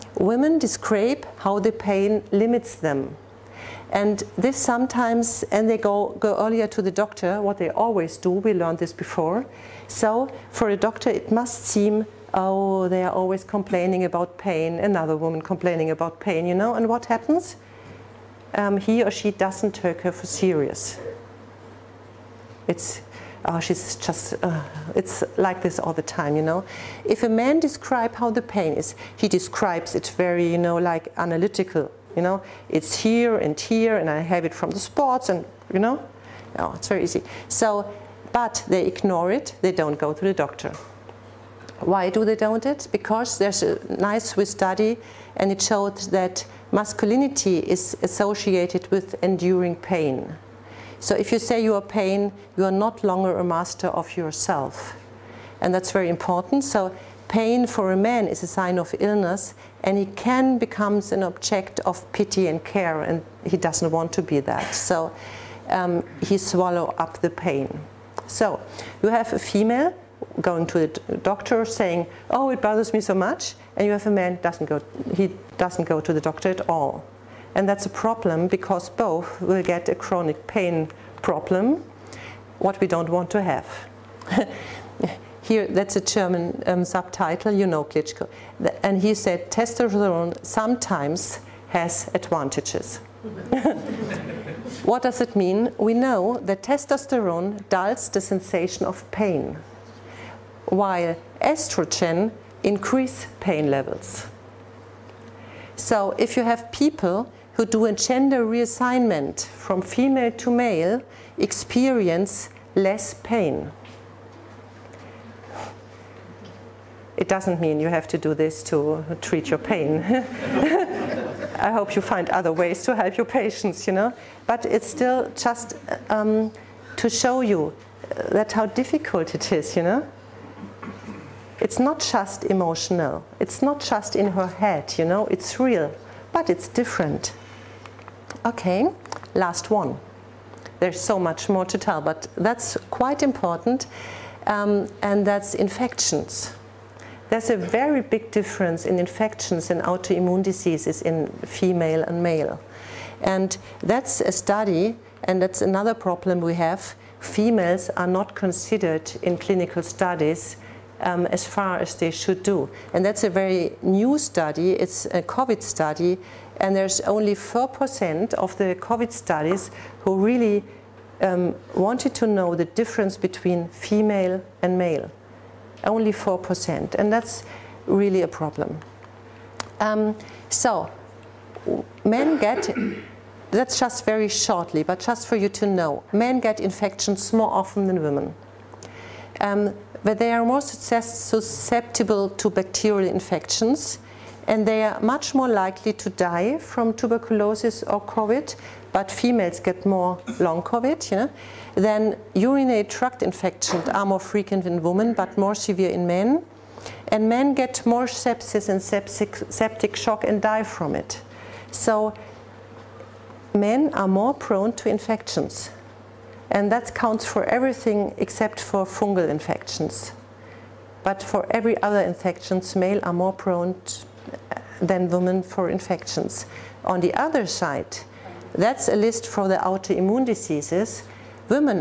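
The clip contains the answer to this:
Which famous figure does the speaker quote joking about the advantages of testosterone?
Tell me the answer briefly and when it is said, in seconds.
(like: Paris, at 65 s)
Klitschko, at 87 s.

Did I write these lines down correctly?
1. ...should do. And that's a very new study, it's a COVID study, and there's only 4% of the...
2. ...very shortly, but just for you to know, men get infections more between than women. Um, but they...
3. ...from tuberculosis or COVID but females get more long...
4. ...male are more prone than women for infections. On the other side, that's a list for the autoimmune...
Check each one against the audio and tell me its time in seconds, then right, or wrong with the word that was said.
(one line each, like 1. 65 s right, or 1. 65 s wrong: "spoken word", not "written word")
1. 162 s right
2. 184 s wrong: "often", not "between"
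3. 196 s right
4. 222 s right.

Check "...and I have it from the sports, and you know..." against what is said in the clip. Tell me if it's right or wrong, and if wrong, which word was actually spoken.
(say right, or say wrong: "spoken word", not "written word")
right.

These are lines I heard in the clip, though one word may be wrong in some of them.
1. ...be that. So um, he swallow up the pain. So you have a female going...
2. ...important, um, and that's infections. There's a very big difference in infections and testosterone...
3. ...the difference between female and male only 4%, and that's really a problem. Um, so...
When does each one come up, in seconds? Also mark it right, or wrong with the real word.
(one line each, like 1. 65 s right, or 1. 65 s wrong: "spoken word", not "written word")
1. 64 s right
2. 143 s wrong: "autoimmune", not "testosterone"
3. 172 s right.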